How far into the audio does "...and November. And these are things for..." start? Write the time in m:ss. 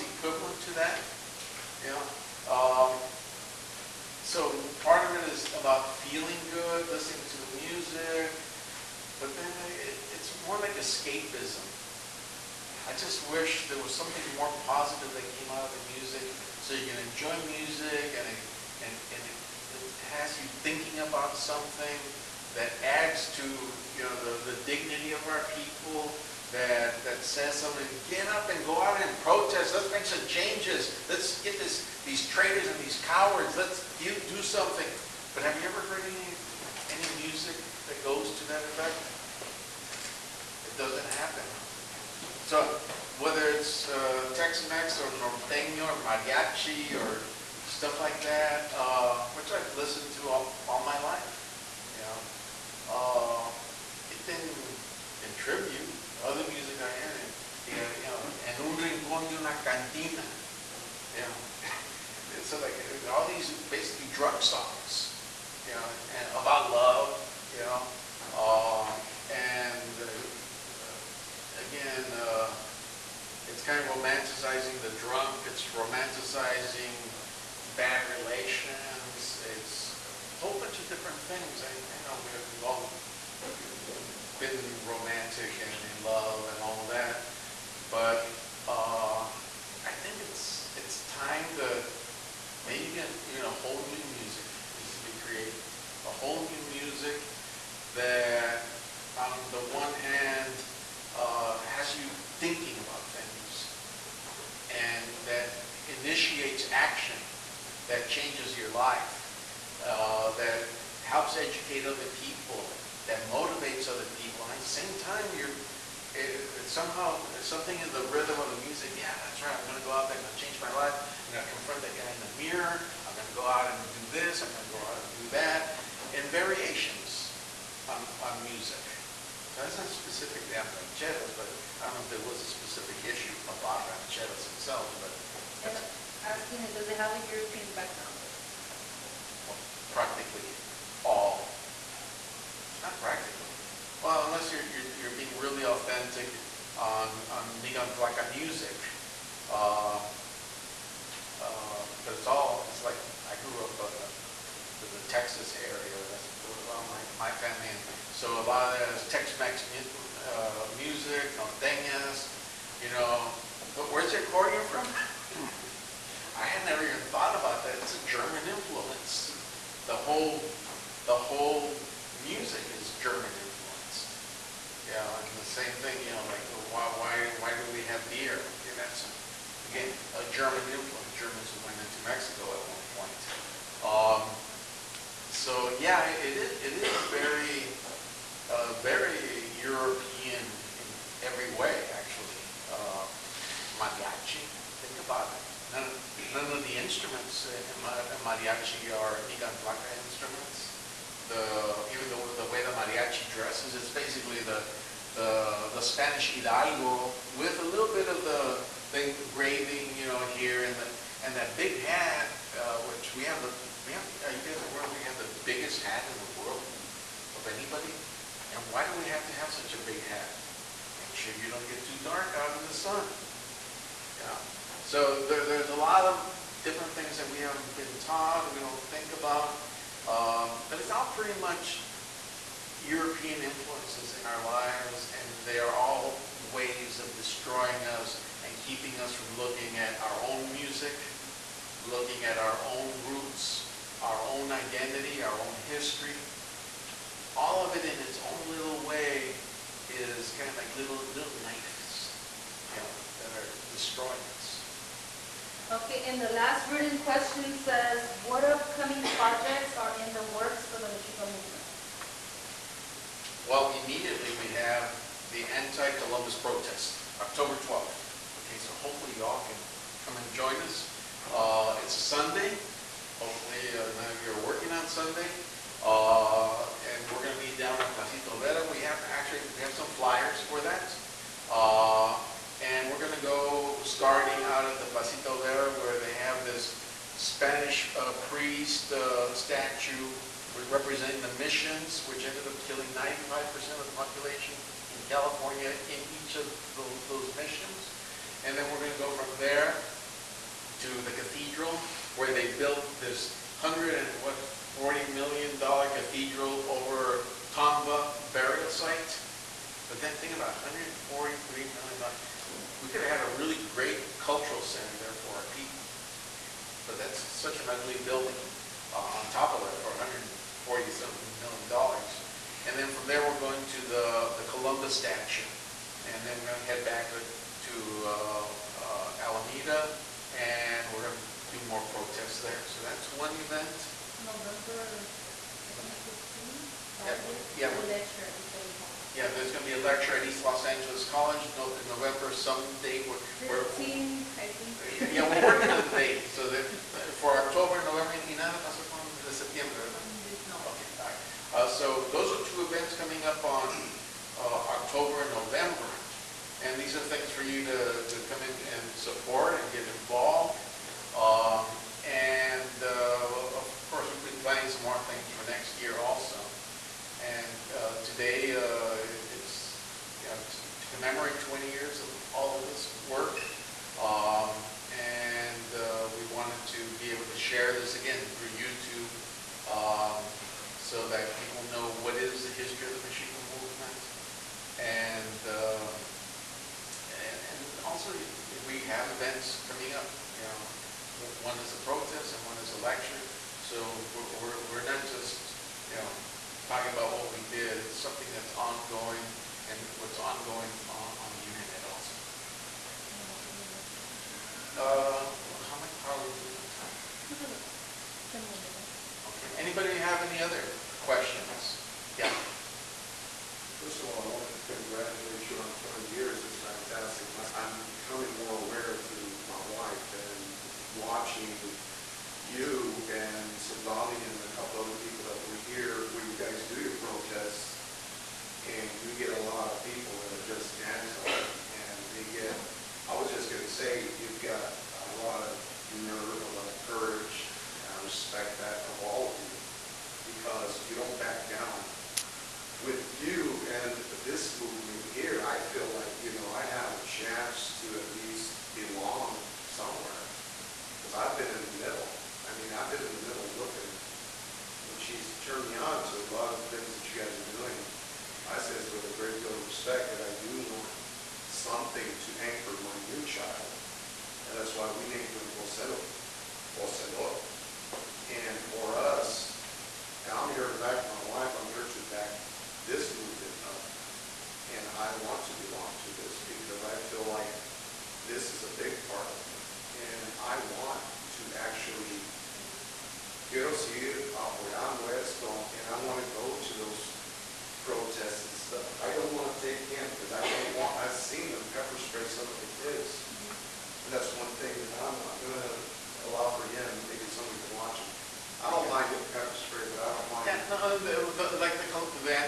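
5:55.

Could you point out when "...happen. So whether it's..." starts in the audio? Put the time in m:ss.
0:41.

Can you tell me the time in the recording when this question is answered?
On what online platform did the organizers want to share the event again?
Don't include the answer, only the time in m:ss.
6:18.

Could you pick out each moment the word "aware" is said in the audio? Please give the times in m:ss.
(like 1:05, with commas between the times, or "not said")
3:34, 6:58.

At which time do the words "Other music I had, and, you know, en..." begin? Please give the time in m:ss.
0:56.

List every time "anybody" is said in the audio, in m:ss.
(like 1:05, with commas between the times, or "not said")
3:37, 6:49.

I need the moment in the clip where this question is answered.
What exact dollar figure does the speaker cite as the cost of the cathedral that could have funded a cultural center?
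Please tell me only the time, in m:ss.
5:10.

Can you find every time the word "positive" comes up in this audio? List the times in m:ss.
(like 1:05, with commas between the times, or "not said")
0:14.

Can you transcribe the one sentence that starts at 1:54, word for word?
And at the same time, you're it, it somehow something in the rhythm of the music.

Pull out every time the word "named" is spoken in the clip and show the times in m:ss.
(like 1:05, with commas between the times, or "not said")
not said.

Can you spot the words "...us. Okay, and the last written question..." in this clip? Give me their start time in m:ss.
4:14.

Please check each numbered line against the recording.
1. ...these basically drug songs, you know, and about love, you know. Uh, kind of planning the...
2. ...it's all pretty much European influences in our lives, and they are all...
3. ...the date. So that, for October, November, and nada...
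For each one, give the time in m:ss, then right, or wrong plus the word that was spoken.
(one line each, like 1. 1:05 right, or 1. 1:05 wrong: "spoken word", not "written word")
1. 1:03 wrong: "romanticizing", not "planning"
2. 3:50 right
3. 5:45 right.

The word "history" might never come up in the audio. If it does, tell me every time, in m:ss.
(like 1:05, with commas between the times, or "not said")
4:05, 6:22.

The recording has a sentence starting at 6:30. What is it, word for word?
You know, one is a protest and one is a lecture.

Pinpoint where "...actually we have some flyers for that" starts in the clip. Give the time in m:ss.
4:39.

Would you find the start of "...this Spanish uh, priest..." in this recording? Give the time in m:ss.
4:46.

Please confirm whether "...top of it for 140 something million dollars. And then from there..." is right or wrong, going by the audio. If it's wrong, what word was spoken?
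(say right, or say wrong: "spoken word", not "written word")
right.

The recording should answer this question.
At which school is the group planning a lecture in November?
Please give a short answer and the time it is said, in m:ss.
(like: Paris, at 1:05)
East Los Angeles College, at 5:40.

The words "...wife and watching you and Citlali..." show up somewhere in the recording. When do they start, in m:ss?
6:59.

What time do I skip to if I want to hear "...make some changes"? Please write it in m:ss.
0:29.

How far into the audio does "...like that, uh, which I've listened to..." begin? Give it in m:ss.
0:47.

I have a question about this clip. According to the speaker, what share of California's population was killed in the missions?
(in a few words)
95%.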